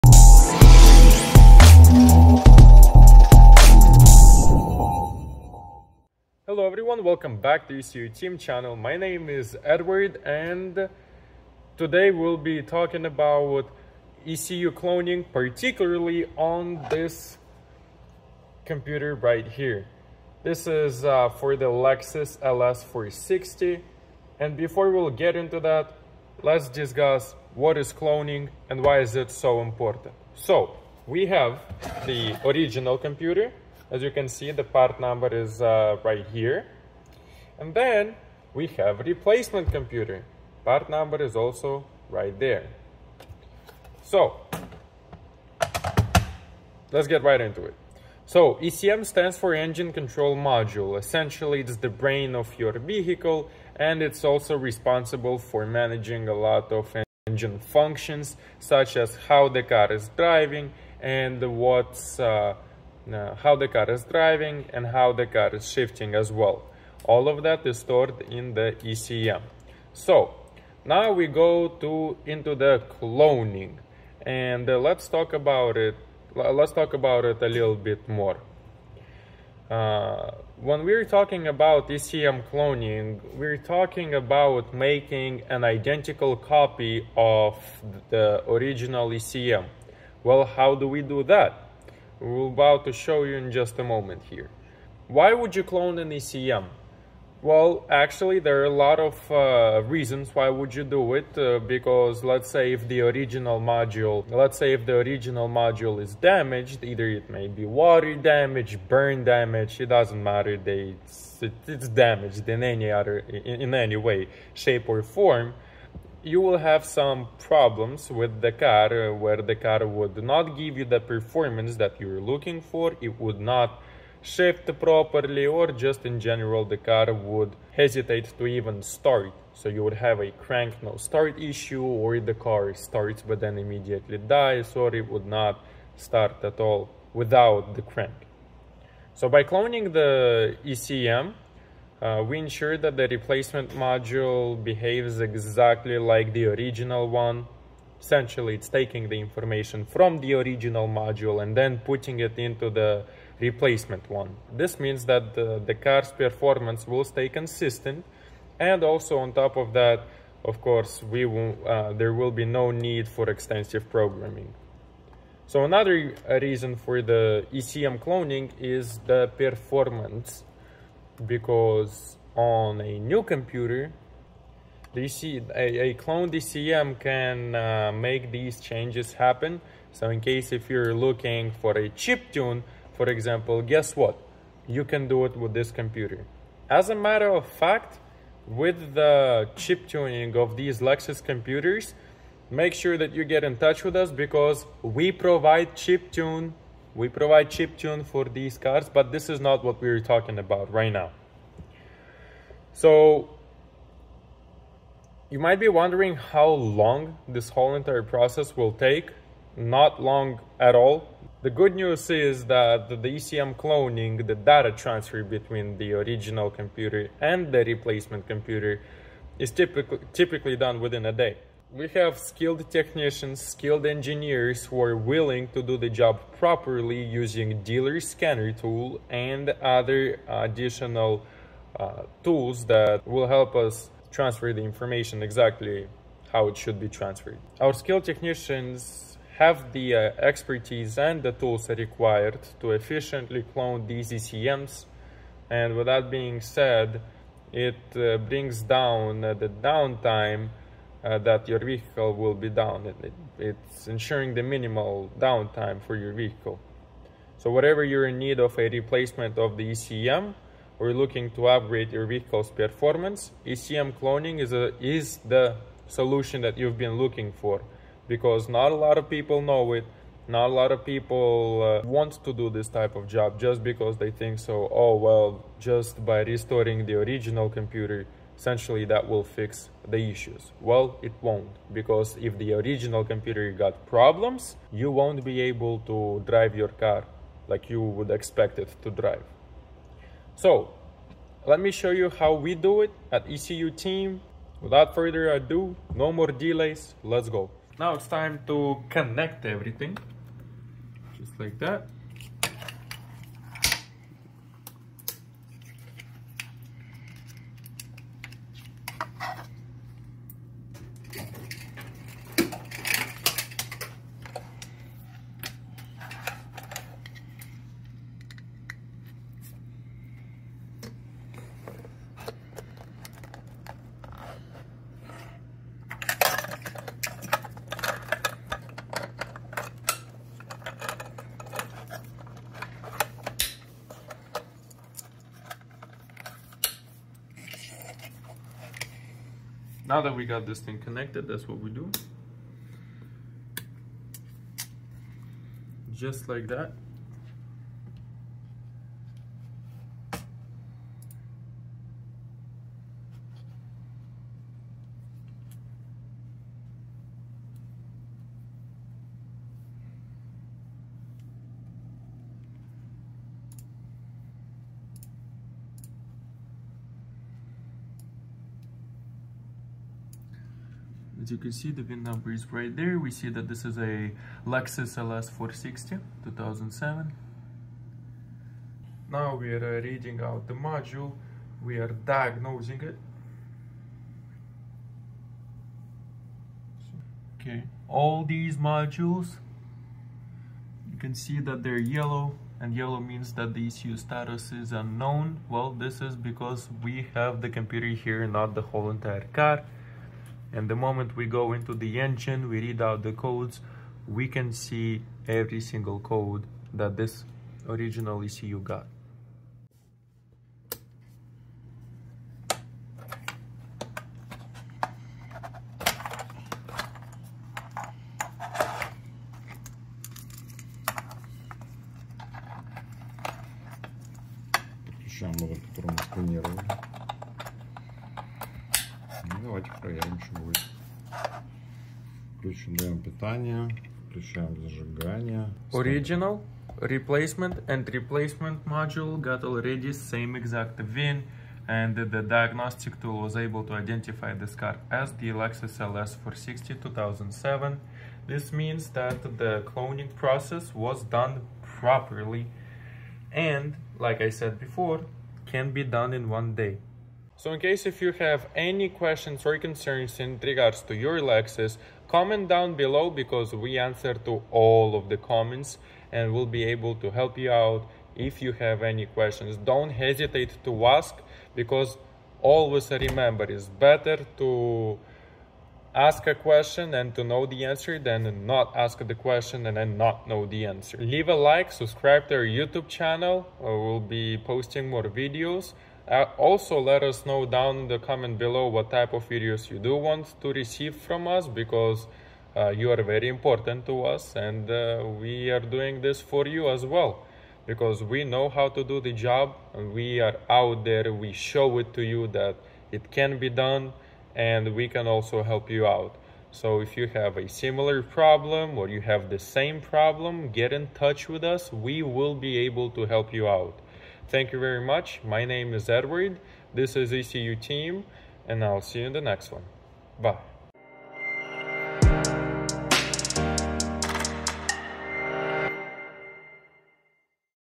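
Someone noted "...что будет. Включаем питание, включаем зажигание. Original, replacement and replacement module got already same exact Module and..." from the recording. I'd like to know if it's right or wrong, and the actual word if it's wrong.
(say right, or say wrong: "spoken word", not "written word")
wrong: "VIN", not "Module".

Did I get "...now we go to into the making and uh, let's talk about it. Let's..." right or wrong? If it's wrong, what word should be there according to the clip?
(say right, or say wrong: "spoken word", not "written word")
wrong: "cloning", not "making".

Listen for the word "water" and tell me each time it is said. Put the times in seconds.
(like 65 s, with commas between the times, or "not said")
107 s.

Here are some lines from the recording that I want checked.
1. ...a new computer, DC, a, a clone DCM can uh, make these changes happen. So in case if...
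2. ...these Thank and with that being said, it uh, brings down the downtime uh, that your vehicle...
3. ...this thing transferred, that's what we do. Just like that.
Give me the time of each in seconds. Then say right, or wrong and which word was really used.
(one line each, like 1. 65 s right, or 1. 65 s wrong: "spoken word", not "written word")
1. 172 s right
2. 243 s wrong: "ECMs", not "Thank"
3. 340 s wrong: "connected", not "transferred".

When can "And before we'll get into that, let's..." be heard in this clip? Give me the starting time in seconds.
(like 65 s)
24 s.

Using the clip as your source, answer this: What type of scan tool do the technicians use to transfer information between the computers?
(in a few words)
dealer scanner tool.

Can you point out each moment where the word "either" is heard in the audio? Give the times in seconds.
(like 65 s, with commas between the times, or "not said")
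106 s.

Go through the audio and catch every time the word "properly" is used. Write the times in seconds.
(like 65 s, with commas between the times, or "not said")
124 s, 226 s, 451 s.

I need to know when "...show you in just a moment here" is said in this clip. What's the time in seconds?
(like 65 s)
92 s.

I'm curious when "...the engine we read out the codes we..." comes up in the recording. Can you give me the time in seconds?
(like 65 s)
401 s.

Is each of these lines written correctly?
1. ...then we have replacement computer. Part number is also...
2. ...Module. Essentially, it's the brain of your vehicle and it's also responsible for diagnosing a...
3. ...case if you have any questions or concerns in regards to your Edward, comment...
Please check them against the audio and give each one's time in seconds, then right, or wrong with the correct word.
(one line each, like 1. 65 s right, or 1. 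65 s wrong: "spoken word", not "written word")
1. 37 s right
2. 50 s wrong: "managing", not "diagnosing"
3. 457 s wrong: "Lexus", not "Edward".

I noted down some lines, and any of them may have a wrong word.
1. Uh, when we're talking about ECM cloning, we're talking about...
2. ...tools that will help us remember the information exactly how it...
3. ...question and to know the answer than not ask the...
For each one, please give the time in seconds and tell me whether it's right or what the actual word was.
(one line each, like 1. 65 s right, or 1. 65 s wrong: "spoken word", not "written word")
1. 79 s right
2. 232 s wrong: "transfer", not "remember"
3. 476 s right.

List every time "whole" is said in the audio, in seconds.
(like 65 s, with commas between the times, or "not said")
207 s, 398 s.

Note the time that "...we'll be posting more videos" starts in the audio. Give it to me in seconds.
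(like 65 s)
483 s.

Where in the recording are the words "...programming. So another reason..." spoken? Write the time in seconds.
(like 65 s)
163 s.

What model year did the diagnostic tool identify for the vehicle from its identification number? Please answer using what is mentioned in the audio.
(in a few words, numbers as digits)
2007.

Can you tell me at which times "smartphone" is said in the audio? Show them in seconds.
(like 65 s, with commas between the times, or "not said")
not said.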